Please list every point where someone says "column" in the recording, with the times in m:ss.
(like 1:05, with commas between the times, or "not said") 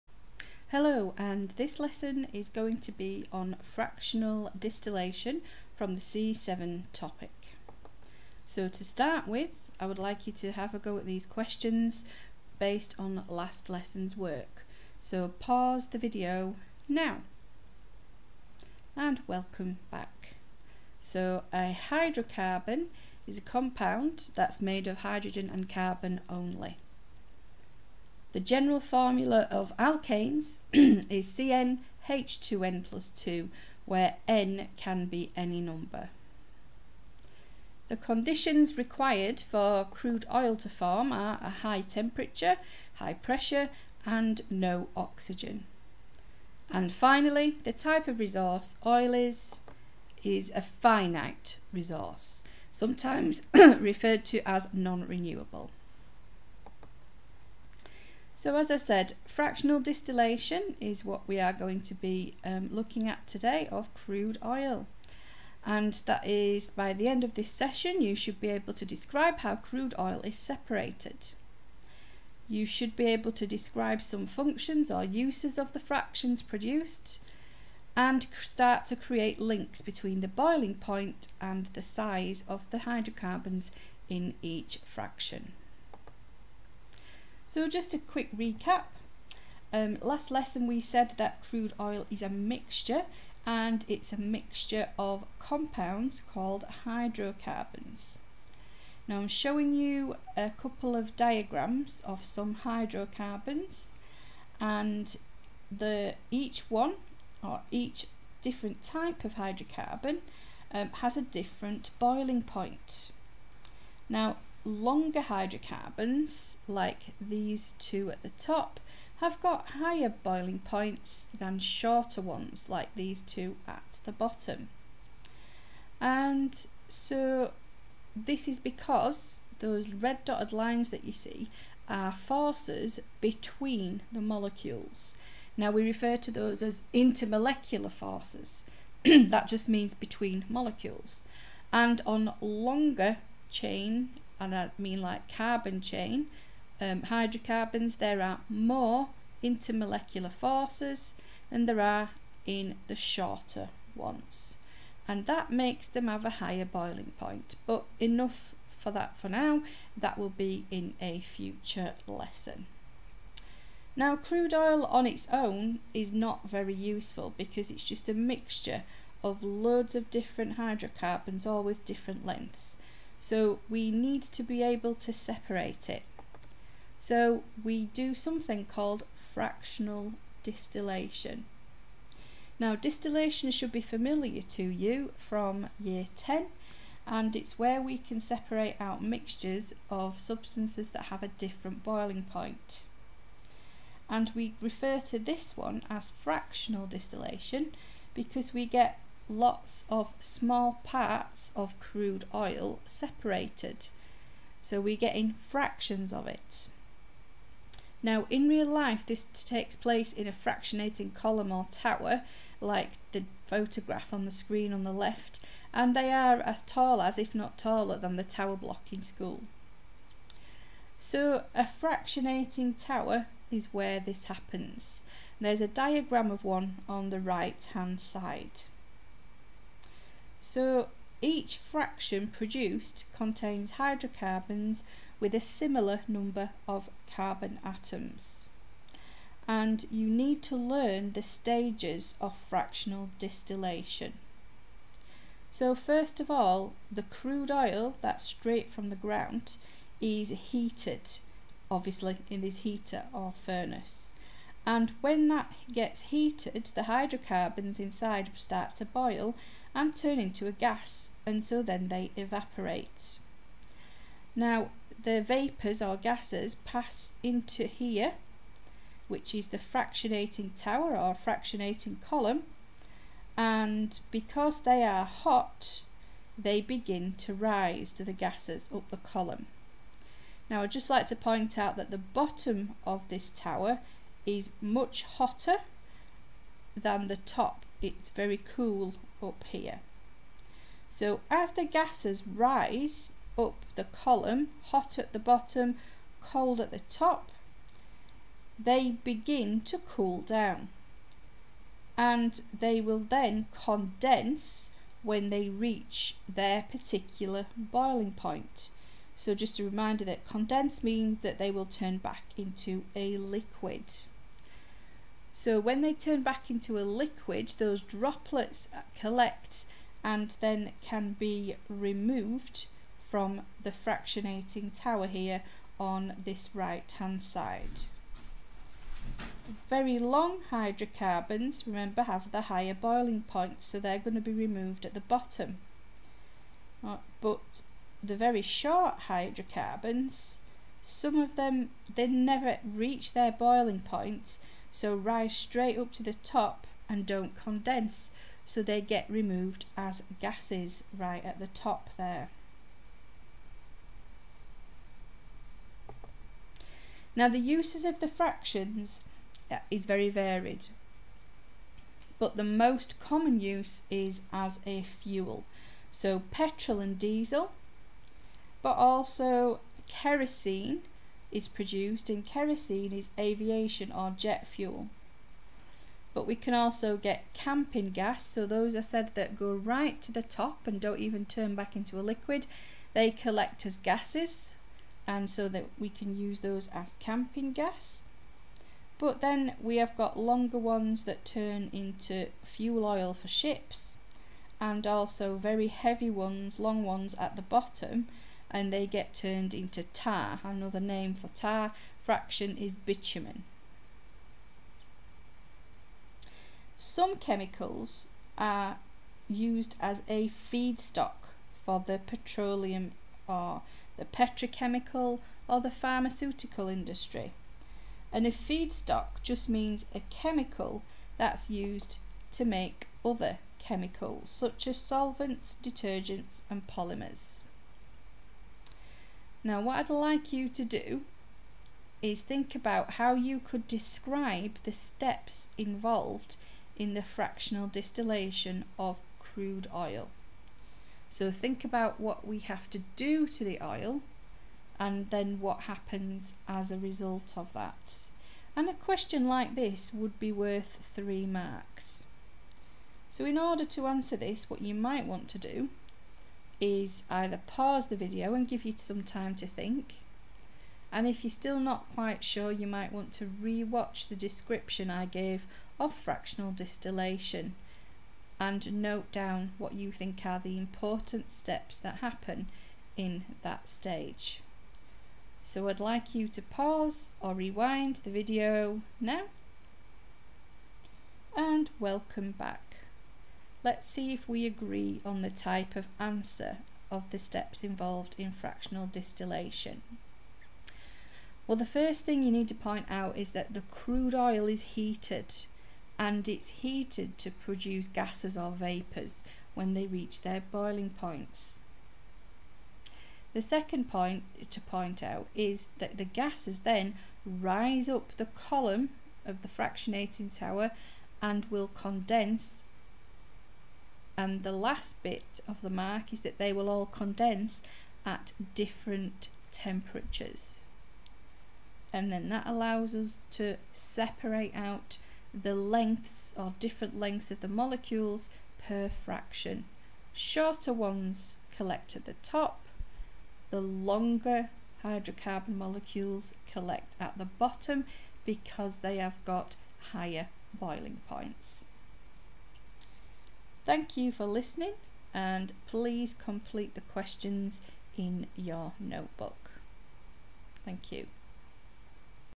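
3:31, 4:32, 4:38, 4:53, 8:28.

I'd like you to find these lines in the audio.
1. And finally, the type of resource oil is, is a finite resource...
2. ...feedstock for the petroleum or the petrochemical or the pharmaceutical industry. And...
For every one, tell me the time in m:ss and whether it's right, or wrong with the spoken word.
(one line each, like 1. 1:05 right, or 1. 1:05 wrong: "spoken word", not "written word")
1. 0:46 right
2. 6:50 right.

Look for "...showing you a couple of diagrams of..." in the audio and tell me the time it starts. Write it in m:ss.
1:39.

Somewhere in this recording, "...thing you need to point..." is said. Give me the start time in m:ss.
8:12.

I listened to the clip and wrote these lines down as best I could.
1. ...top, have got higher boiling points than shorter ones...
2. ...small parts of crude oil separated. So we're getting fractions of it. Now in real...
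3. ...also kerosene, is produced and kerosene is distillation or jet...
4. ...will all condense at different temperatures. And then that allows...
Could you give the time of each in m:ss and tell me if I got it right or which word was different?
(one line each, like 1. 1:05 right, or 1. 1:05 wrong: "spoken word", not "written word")
1. 1:58 right
2. 3:20 right
3. 6:08 wrong: "aviation", not "distillation"
4. 8:36 right.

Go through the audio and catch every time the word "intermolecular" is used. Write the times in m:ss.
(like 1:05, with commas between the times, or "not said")
2:16, 2:29.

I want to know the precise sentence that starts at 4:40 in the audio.
Now I'd just like to point out that the bottom of this tower is much hotter than the top.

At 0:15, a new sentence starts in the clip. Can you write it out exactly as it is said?
So pause the video now and welcome back.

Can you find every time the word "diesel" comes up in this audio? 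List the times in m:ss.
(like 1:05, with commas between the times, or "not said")
6:06.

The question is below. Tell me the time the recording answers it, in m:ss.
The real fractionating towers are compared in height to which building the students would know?
3:38.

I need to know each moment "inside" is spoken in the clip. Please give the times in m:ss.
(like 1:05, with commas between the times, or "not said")
4:17.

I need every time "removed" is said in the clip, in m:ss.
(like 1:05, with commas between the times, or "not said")
5:21, 5:34, 5:49.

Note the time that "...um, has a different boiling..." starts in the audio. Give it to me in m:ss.
1:50.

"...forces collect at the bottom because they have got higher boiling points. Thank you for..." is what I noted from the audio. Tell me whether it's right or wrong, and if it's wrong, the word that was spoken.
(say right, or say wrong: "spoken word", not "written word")
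wrong: "molecules", not "forces".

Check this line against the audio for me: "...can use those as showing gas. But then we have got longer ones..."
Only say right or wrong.
wrong.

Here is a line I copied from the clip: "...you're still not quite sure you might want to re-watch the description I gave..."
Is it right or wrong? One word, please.
right.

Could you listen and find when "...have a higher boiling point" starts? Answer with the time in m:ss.
2:36.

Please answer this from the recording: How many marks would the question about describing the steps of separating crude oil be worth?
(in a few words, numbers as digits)
3.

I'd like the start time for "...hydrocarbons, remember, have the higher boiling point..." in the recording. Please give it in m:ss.
5:30.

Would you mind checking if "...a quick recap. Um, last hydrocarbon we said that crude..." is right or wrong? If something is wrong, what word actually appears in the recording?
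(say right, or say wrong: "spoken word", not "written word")
wrong: "lesson", not "hydrocarbon".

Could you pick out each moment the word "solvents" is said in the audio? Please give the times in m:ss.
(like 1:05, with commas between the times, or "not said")
7:04.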